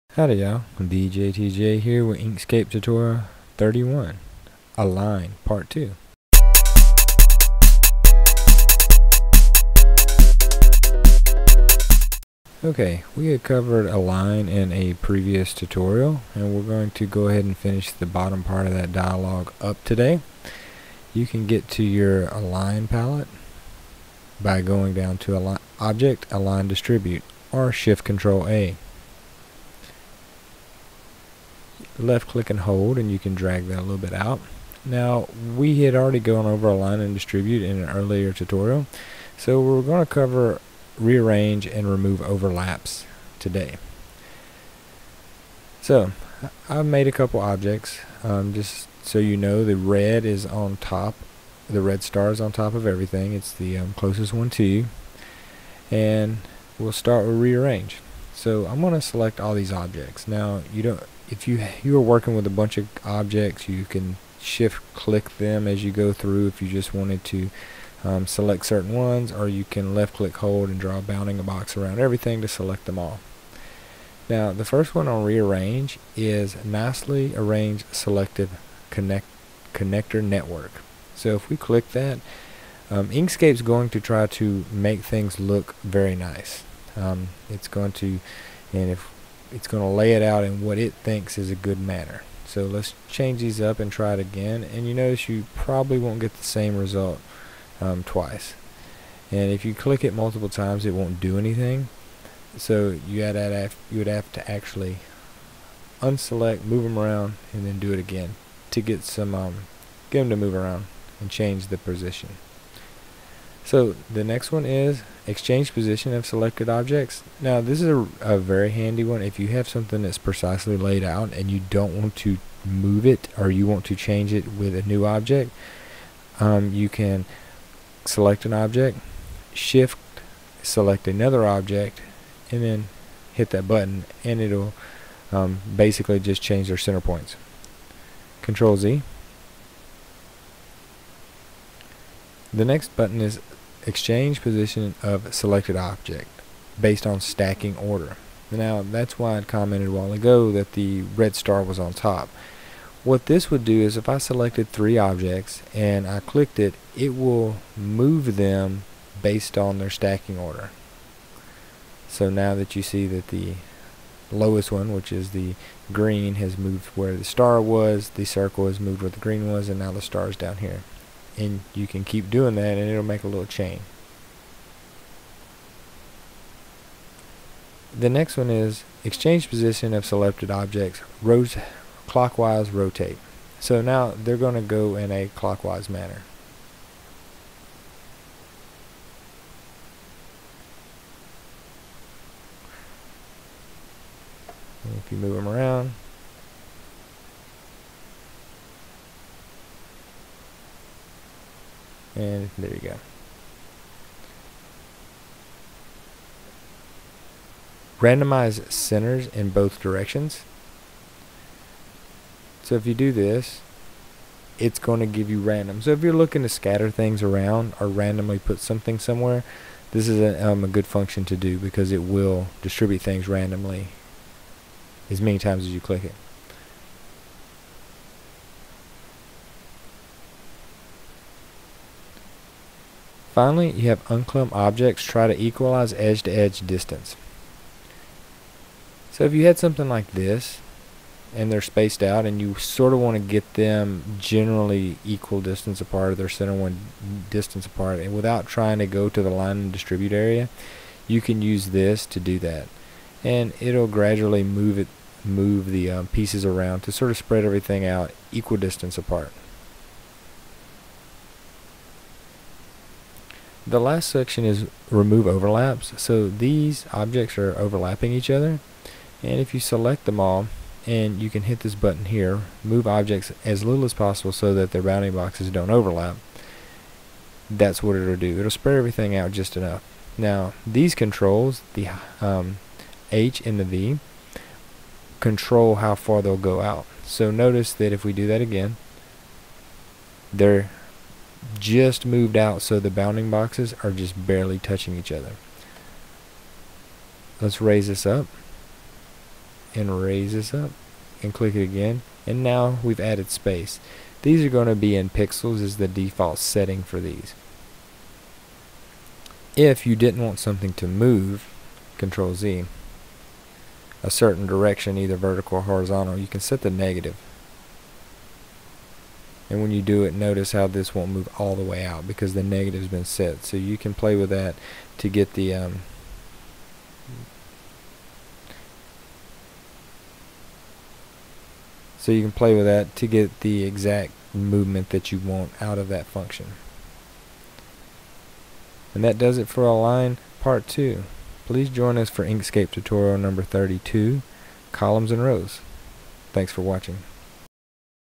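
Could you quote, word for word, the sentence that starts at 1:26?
Um, it's going to, and if it's going to lay it out in what it thinks is a good manner.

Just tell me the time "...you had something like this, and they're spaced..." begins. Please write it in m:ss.
3:59.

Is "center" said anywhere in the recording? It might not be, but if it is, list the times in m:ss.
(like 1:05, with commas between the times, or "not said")
2:16, 3:28, 4:06.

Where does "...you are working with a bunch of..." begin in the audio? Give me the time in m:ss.
1:01.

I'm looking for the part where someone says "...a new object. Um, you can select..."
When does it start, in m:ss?
2:04.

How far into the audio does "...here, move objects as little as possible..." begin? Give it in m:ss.
4:32.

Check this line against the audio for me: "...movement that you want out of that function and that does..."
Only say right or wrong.
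right.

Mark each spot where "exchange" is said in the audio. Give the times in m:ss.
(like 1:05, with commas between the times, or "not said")
1:55, 2:23, 2:59.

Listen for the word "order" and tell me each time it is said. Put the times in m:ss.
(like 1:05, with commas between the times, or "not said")
2:27, 2:40.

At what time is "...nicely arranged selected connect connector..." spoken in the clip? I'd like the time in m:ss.
1:16.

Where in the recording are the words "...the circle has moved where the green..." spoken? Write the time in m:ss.
2:48.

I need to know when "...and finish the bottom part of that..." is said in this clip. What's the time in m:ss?
0:17.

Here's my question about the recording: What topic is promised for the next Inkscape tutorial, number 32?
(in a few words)
Columns and Rows.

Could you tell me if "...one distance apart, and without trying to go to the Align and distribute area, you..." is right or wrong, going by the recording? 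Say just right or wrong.
right.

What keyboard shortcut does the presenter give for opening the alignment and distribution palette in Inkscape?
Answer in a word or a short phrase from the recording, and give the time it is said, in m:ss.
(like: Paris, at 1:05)
Shift-Control-A, at 0:27.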